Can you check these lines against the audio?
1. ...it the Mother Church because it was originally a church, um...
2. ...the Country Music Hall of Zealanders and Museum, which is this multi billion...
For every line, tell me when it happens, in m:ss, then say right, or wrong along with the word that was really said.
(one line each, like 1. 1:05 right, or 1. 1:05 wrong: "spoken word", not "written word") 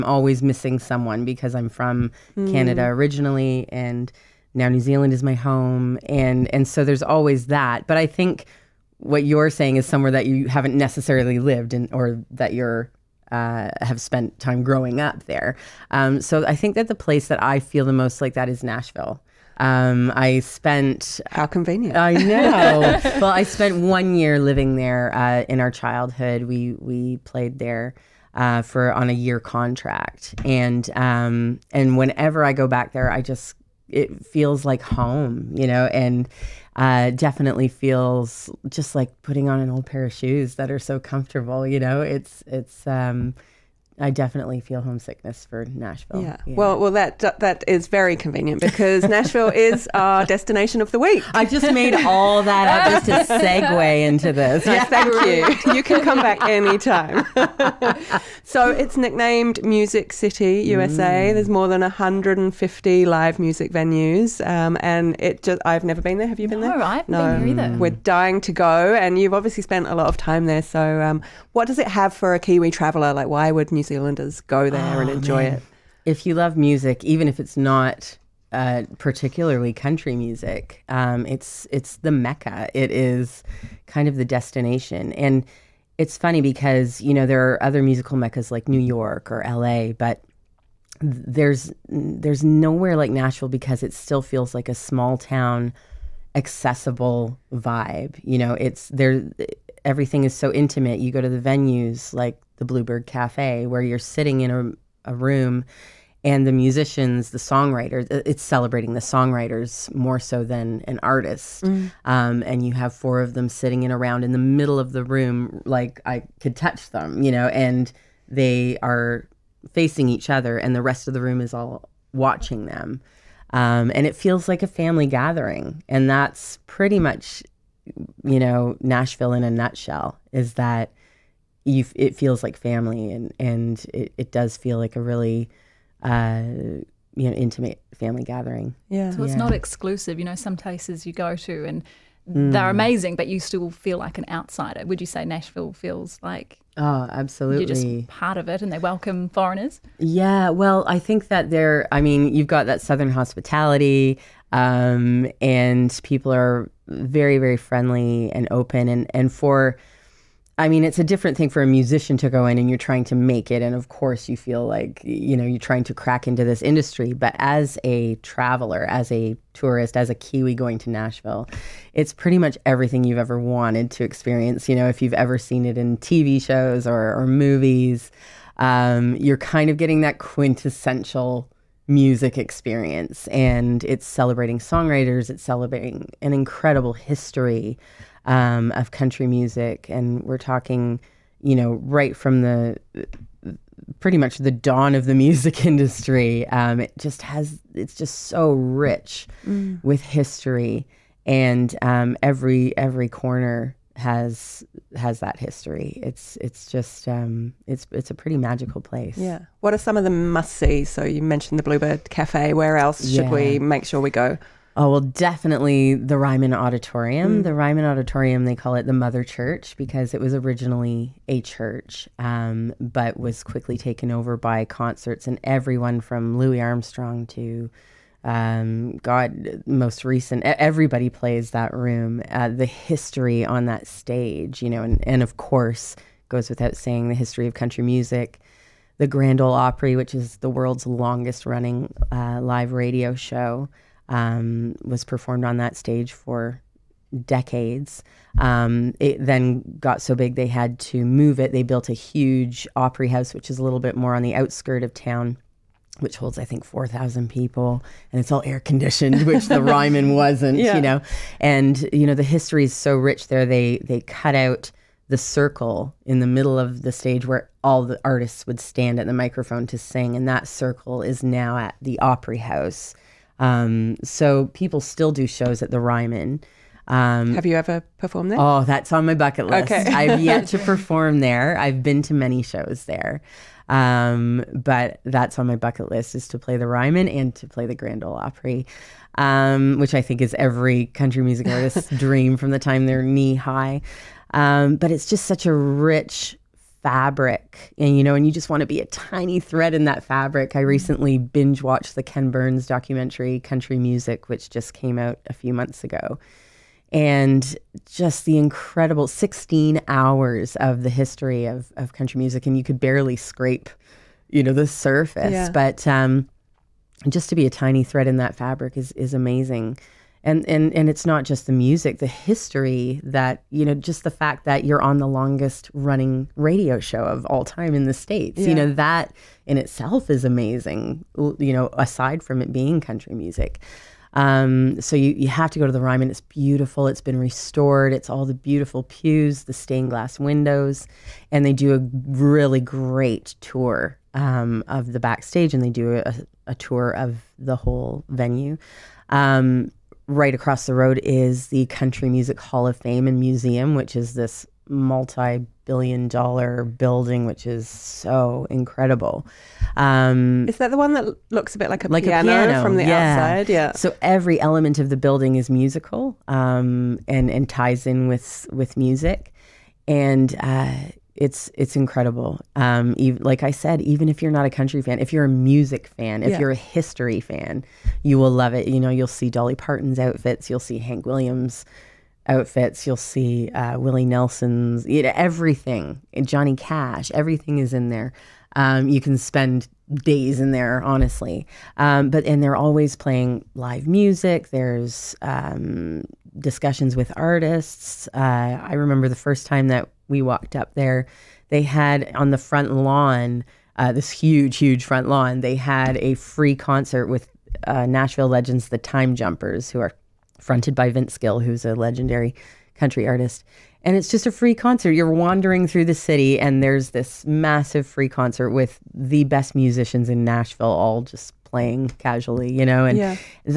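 1. 3:38 right
2. 5:51 wrong: "Fame", not "Zealanders".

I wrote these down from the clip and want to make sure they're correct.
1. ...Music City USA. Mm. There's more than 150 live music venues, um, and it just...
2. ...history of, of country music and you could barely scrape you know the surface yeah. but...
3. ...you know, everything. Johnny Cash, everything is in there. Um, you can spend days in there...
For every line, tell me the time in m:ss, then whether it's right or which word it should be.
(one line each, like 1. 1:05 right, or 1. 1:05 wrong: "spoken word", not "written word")
1. 0:59 right
2. 5:10 right
3. 6:24 right.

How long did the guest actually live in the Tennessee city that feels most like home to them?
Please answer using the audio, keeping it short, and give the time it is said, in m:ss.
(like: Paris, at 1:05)
1 year, at 0:23.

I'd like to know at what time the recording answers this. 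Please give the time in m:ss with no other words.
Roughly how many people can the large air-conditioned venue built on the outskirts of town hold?
4:16.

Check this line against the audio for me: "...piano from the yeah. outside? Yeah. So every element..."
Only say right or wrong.
right.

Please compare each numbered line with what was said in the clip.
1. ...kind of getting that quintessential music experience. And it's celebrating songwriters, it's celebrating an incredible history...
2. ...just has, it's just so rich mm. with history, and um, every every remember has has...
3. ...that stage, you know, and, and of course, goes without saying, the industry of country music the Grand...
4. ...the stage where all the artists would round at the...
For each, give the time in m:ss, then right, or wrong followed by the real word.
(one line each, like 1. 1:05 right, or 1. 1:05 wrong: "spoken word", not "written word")
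1. 2:59 right
2. 3:16 wrong: "corner", not "remember"
3. 3:53 wrong: "history", not "industry"
4. 4:26 wrong: "stand", not "round".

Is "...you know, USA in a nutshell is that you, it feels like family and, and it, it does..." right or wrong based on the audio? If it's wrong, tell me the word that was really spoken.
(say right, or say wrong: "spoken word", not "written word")
wrong: "Nashville", not "USA".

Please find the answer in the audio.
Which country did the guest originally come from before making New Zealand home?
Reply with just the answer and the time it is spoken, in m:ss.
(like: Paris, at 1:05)
Canada, at 0:02.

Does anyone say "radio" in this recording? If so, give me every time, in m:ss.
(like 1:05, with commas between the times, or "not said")
4:02, 5:26.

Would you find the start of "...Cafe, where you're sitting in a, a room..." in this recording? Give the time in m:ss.
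1:43.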